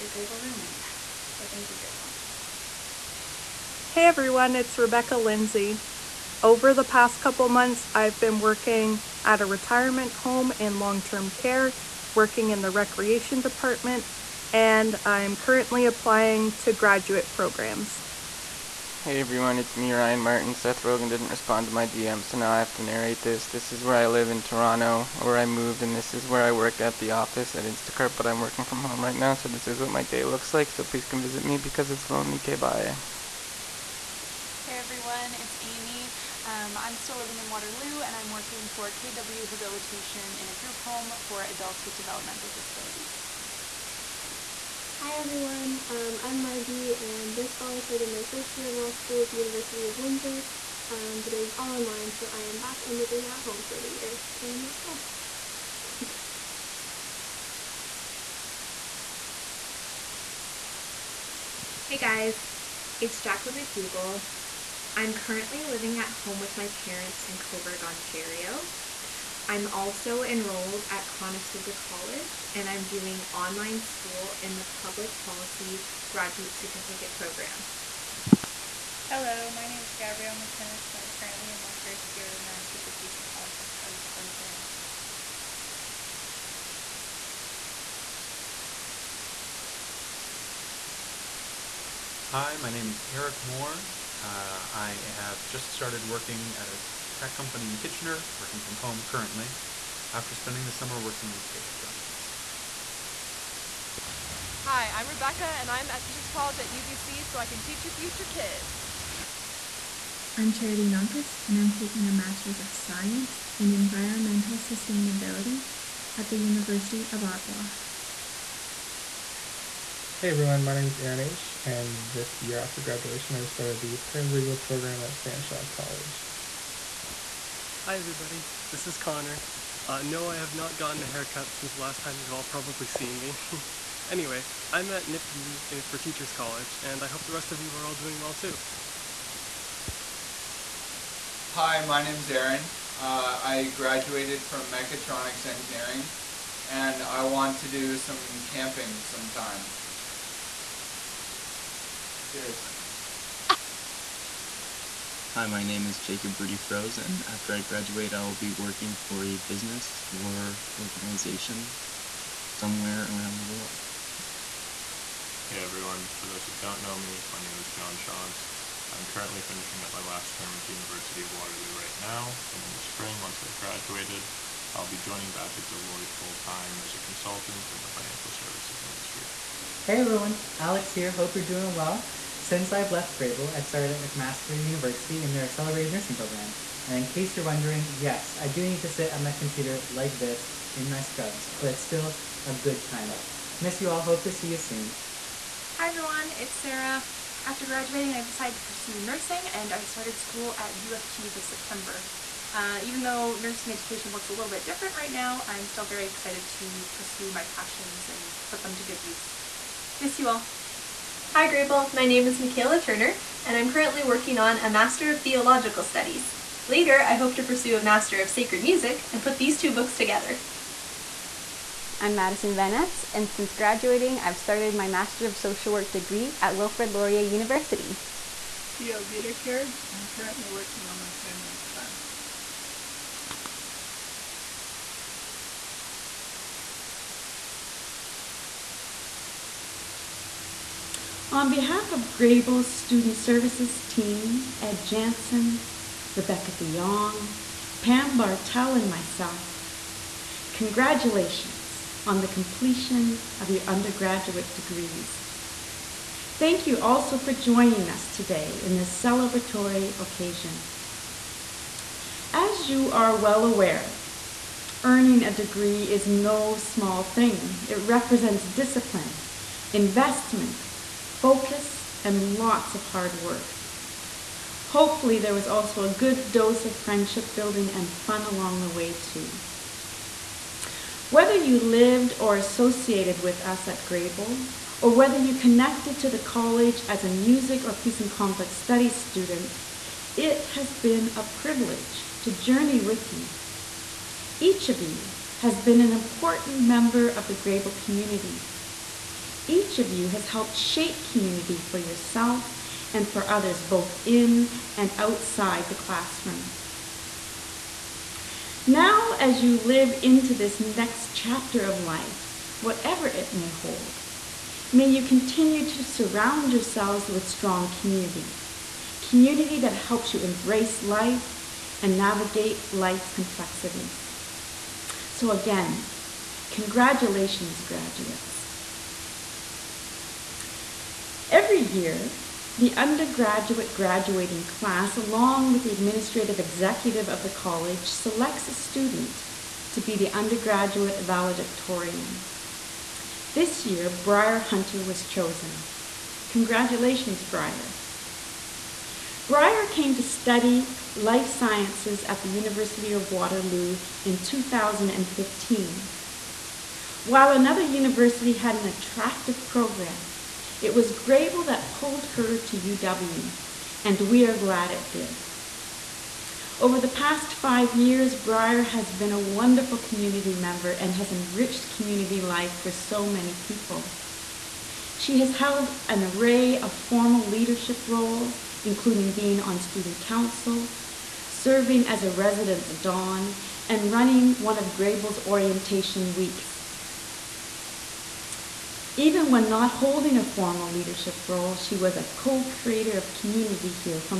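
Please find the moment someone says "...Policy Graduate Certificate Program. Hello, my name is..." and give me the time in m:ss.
1:15.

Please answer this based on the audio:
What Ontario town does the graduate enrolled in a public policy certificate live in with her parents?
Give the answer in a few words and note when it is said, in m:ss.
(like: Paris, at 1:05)
Cobourg, at 1:07.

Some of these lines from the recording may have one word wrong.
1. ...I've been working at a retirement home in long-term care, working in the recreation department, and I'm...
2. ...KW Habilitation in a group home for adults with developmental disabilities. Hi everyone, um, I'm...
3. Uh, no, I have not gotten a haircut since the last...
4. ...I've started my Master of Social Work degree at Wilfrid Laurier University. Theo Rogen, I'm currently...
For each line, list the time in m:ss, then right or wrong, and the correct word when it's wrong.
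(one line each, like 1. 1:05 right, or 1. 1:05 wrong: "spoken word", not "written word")
1. 0:07 right
2. 0:38 right
3. 2:09 right
4. 3:44 wrong: "Viterker", not "Rogen".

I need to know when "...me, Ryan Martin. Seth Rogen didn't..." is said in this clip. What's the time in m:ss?
0:19.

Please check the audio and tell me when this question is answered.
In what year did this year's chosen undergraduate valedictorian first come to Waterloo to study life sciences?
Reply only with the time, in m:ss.
5:54.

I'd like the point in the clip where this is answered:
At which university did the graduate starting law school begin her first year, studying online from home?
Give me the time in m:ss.
0:49.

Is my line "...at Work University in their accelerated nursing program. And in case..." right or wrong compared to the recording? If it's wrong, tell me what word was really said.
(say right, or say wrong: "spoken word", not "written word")
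wrong: "McMaster", not "Work".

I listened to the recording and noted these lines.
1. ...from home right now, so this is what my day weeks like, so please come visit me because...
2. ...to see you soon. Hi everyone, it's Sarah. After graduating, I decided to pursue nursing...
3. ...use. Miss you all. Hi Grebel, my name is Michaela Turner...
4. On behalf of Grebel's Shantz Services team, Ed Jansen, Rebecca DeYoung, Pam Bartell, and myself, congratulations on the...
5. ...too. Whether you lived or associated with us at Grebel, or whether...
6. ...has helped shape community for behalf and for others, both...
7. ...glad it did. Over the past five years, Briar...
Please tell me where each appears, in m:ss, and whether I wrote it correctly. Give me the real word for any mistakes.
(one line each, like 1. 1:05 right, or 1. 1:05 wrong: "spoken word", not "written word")
1. 0:28 wrong: "looks", not "weeks"
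2. 3:14 right
3. 3:29 right
4. 4:01 wrong: "Student", not "Shantz"
5. 4:38 right
6. 5:00 wrong: "yourself", not "behalf"
7. 6:04 right.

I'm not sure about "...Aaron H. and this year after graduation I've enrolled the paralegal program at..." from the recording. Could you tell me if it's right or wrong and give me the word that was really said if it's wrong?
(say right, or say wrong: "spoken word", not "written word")
wrong: "started", not "enrolled".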